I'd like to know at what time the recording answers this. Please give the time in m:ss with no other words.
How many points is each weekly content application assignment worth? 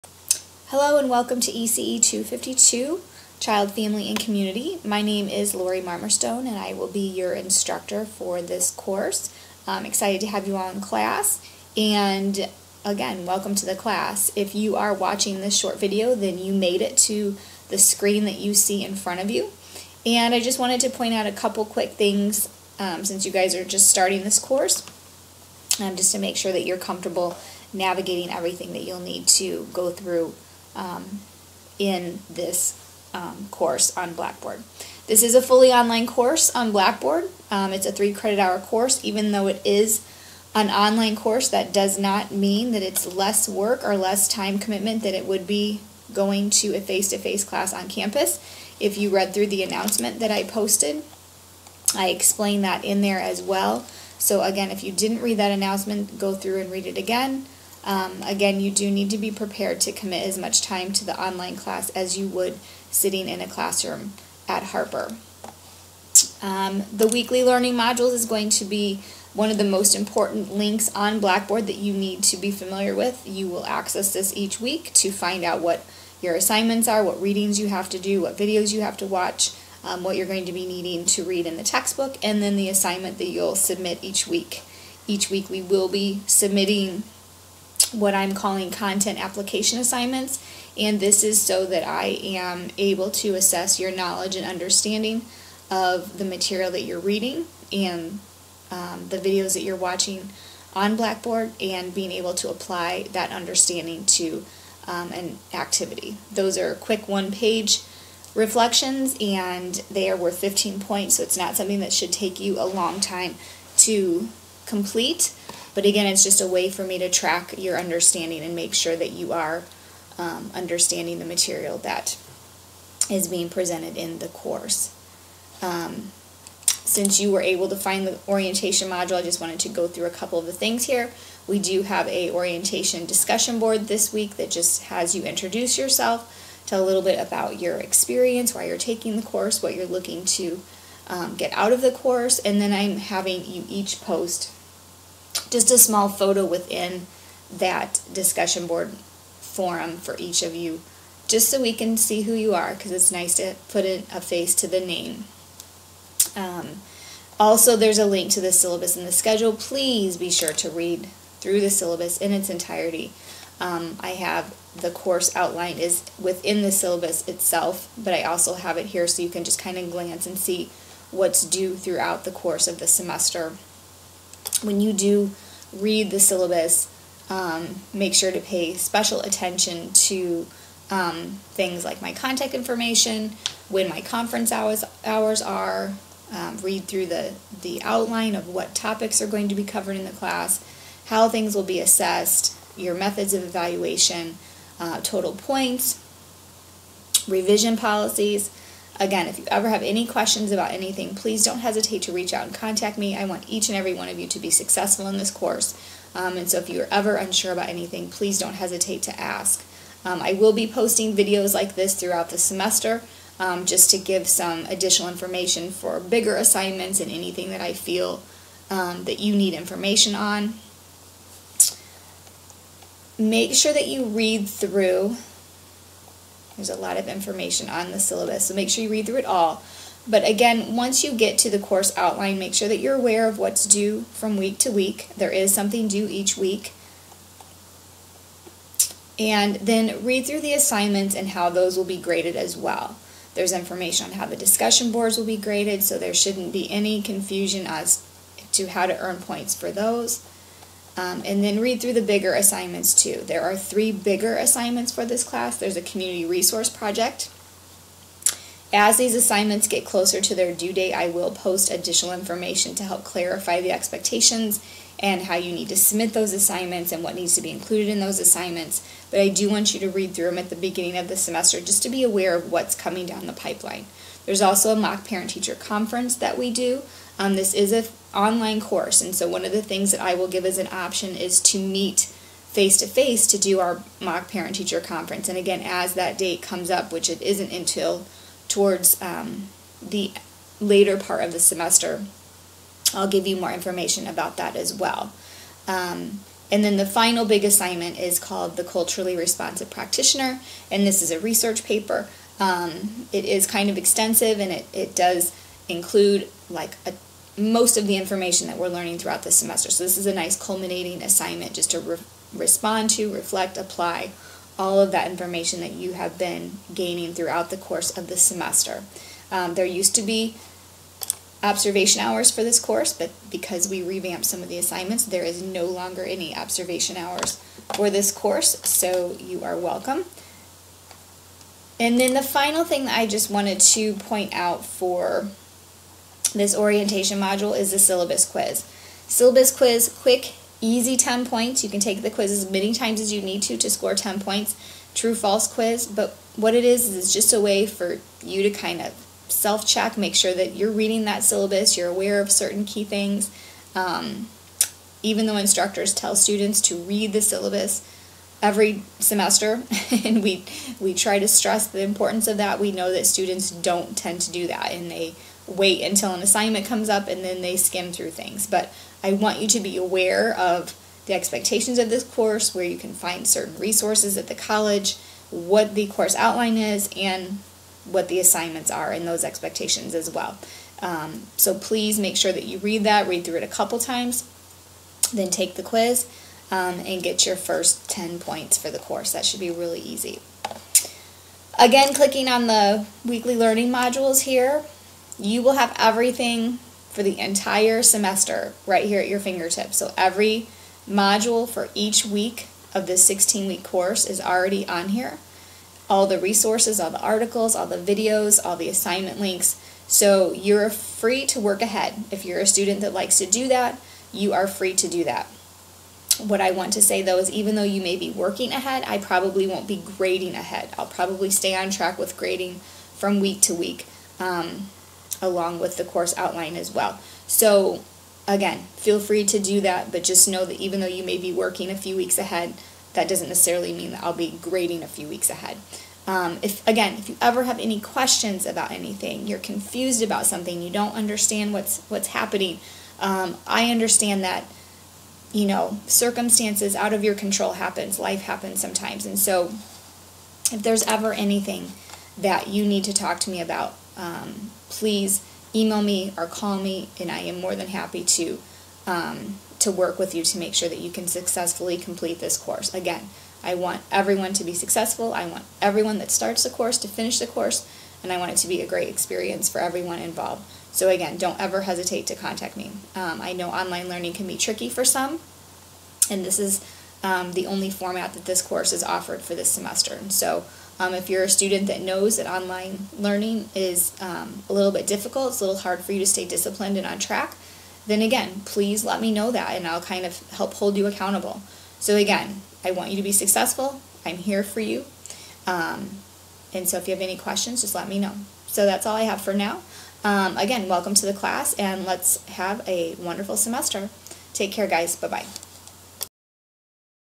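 1:50.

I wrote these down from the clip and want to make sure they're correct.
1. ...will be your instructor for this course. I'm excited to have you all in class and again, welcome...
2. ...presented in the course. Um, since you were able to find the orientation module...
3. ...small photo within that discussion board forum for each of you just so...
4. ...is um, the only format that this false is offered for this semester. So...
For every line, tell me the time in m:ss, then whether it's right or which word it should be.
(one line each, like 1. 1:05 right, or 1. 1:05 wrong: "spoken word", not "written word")
1. 0:06 right
2. 2:03 right
3. 2:25 right
4. 7:56 wrong: "course", not "false".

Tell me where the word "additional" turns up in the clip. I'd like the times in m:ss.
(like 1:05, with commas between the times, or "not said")
3:34, 4:21.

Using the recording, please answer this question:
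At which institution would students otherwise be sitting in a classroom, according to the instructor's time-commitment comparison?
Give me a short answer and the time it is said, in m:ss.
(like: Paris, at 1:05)
Harper, at 1:04.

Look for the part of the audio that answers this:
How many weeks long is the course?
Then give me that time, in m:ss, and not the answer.
6:43.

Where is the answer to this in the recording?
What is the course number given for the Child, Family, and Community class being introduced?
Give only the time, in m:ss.
0:01.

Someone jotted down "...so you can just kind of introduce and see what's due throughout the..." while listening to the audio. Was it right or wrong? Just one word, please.
wrong.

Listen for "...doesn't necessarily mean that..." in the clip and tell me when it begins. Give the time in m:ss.
7:13.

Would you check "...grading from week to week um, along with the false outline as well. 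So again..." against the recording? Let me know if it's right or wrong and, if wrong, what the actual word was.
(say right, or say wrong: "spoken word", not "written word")
wrong: "course", not "false".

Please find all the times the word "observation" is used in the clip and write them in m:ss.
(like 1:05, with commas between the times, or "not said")
5:21, 5:26.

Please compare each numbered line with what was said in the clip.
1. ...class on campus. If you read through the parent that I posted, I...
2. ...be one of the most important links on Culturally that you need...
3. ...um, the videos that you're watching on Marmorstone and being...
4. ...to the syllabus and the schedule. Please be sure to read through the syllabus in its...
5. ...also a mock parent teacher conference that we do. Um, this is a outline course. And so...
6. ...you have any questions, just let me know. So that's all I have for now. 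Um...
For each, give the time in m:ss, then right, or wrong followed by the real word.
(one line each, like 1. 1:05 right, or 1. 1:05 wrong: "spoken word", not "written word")
1. 0:47 wrong: "announcement", not "parent"
2. 1:08 wrong: "Blackboard", not "Culturally"
3. 1:38 wrong: "Blackboard", not "Marmorstone"
4. 2:38 right
5. 4:34 wrong: "online", not "outline"
6. 8:16 right.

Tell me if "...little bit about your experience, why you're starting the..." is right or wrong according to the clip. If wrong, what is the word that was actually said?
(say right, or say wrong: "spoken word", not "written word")
wrong: "taking", not "starting".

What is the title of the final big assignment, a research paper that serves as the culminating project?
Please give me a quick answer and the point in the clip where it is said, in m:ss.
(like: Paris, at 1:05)
Culturally Responsive Practitioner, at 4:58.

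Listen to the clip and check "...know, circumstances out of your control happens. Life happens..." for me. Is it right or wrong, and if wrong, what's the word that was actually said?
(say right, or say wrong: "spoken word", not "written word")
right.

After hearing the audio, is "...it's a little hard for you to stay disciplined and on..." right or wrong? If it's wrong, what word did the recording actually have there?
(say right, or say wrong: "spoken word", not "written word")
right.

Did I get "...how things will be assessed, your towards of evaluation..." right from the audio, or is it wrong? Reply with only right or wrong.
wrong.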